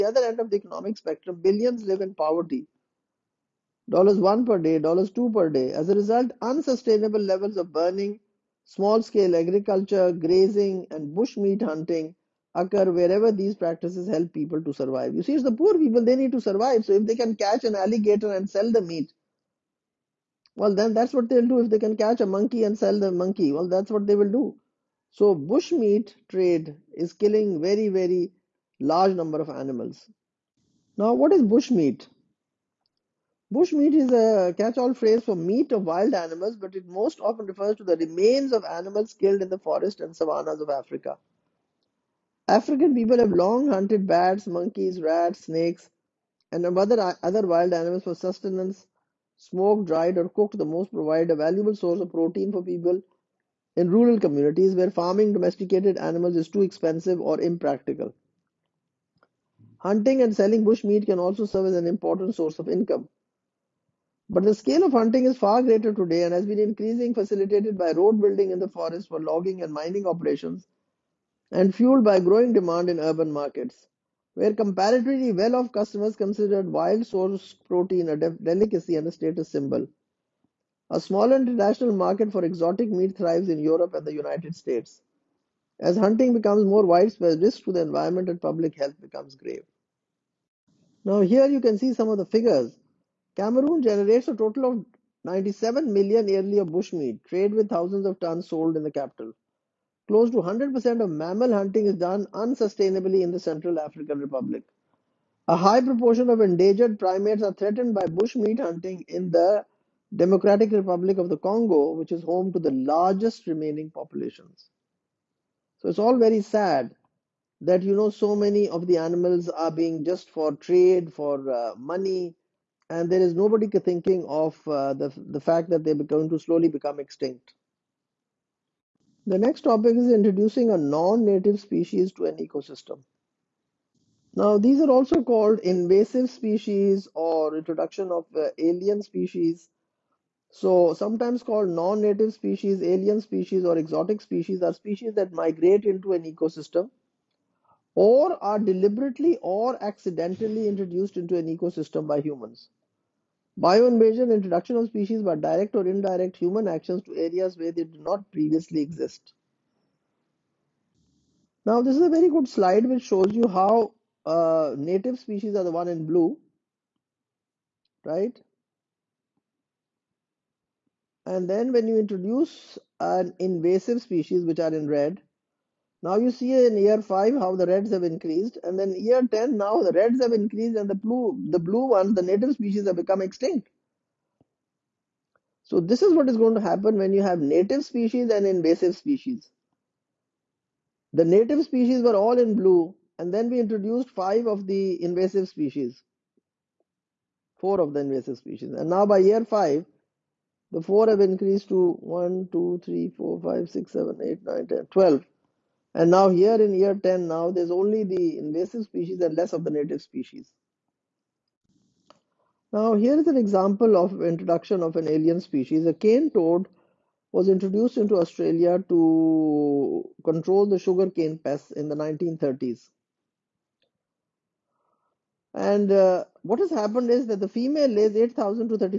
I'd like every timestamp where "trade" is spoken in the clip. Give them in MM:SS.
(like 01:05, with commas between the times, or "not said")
00:26, 01:37, 02:00.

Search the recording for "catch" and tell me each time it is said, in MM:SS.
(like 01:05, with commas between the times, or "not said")
00:17, 00:21, 00:34.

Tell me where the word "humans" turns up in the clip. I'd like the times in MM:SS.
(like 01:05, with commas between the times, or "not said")
02:32, 02:36.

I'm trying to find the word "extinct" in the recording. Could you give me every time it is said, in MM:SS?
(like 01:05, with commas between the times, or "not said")
02:06, 03:03.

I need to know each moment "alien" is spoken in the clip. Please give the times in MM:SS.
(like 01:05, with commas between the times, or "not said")
02:18, 02:22, 03:35.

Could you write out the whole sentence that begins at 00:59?
Hunting and selling bush meat can also serve as an important source of income.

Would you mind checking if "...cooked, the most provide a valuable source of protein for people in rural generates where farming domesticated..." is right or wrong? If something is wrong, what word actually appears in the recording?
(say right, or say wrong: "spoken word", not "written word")
wrong: "communities", not "generates".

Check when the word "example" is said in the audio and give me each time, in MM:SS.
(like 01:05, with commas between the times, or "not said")
03:33.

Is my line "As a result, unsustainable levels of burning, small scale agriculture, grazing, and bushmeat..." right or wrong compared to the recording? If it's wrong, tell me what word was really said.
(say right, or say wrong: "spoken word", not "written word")
right.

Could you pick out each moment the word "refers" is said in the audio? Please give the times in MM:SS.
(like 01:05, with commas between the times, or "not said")
00:37.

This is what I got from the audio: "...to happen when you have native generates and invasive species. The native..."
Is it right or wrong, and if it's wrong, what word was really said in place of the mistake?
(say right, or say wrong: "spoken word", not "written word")
wrong: "species", not "generates".